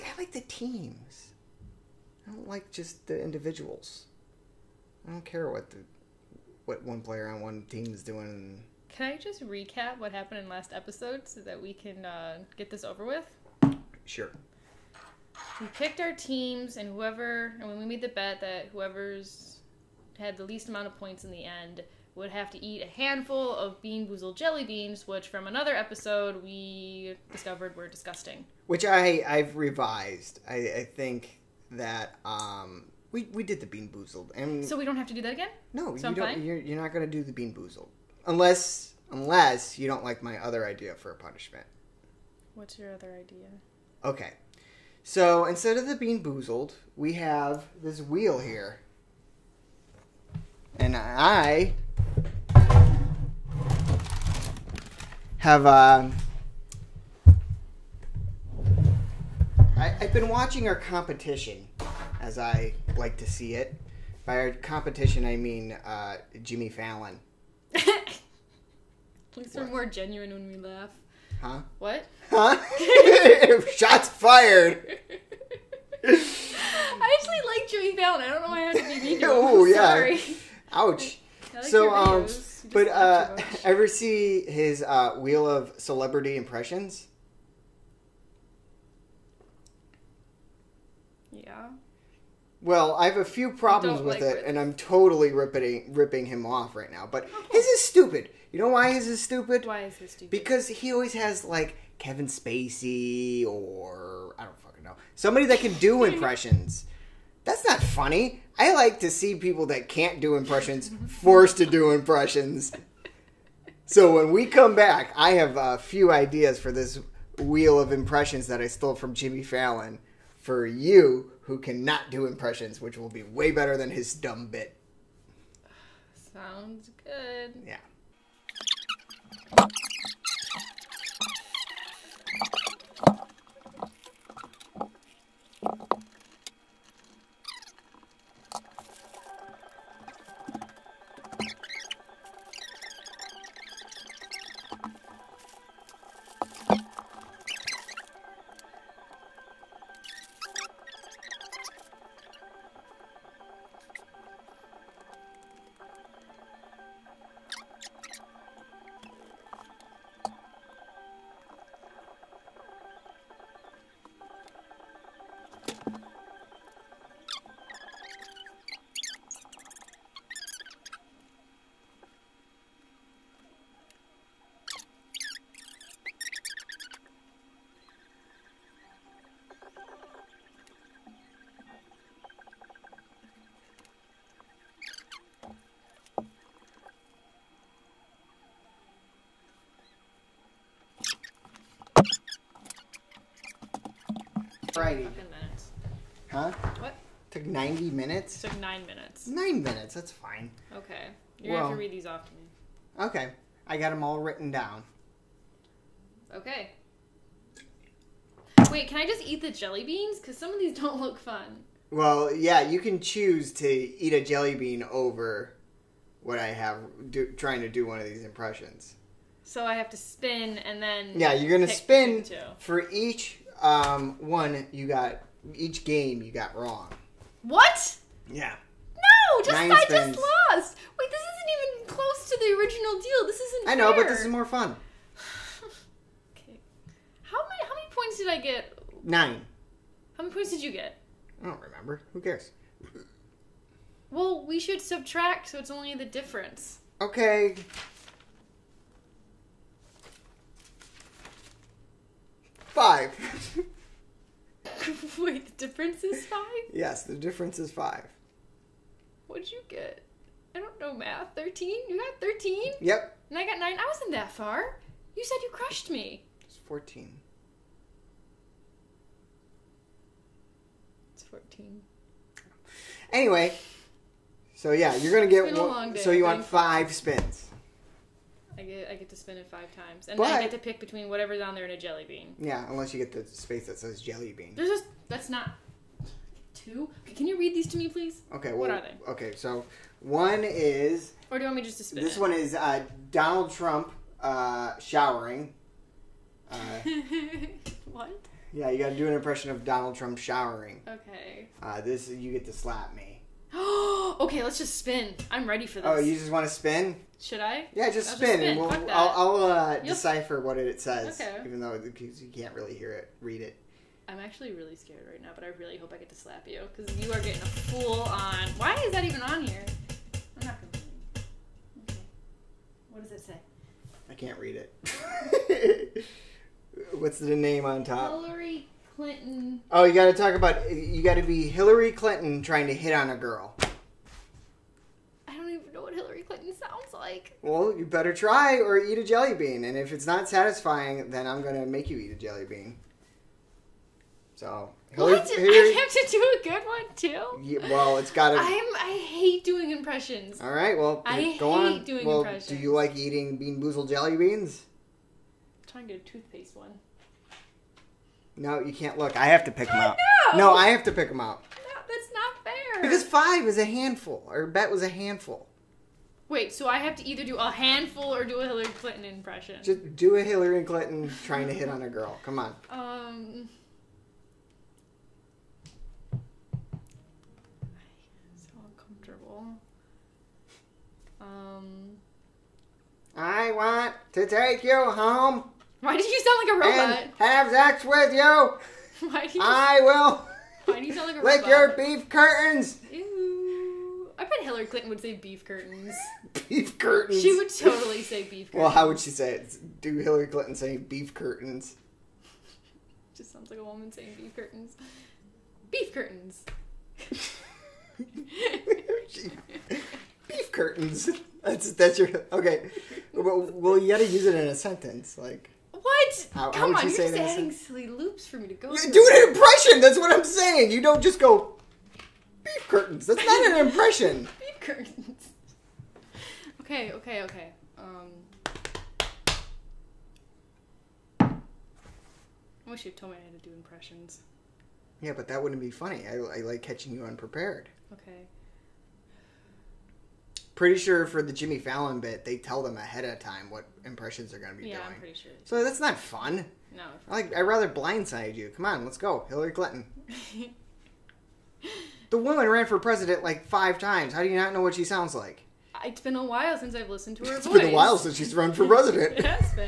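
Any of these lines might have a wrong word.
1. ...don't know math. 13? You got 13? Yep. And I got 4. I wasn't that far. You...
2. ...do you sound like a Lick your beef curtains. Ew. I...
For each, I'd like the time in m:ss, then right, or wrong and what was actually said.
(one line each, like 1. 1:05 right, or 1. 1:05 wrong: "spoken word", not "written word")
1. 4:20 wrong: "9", not "4"
2. 6:30 right.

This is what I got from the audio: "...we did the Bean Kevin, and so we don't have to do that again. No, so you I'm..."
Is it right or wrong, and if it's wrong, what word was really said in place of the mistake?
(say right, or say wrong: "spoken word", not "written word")
wrong: "Boozled", not "Kevin".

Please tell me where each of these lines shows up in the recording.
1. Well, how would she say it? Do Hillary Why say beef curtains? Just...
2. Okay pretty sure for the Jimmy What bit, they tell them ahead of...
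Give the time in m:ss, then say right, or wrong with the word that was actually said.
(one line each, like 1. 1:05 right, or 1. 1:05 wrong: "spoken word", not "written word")
1. 6:38 wrong: "Clinton", not "Why"
2. 7:17 wrong: "Fallon", not "What".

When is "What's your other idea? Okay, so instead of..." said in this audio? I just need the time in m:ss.
0:42.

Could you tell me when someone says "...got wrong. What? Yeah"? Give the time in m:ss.
3:46.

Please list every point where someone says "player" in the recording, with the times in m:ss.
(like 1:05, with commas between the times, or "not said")
0:07.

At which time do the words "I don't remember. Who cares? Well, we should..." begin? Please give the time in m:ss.
4:01.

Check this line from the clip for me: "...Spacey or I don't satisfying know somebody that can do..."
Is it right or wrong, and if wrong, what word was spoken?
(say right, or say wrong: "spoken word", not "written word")
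wrong: "fucking", not "satisfying".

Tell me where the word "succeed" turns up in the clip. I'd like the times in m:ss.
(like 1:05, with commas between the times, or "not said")
not said.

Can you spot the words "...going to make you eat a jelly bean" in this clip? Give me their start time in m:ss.
5:41.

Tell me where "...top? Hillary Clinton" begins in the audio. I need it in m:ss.
5:27.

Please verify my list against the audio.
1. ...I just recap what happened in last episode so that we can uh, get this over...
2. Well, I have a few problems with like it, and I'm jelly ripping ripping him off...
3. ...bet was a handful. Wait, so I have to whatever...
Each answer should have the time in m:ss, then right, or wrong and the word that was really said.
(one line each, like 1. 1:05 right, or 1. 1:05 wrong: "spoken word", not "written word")
1. 0:09 right
2. 1:32 wrong: "totally", not "jelly"
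3. 6:04 wrong: "either", not "whatever".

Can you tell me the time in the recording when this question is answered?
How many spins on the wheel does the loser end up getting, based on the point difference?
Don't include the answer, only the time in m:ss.
4:36.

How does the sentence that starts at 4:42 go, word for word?
Yeah, unless you get the space that says jelly bean.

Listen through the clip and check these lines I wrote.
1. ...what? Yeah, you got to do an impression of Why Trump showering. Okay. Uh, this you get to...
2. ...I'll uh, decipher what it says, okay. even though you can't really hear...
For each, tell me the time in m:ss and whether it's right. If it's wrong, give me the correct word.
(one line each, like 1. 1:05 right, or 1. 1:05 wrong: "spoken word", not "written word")
1. 4:57 wrong: "Donald", not "Why"
2. 5:09 right.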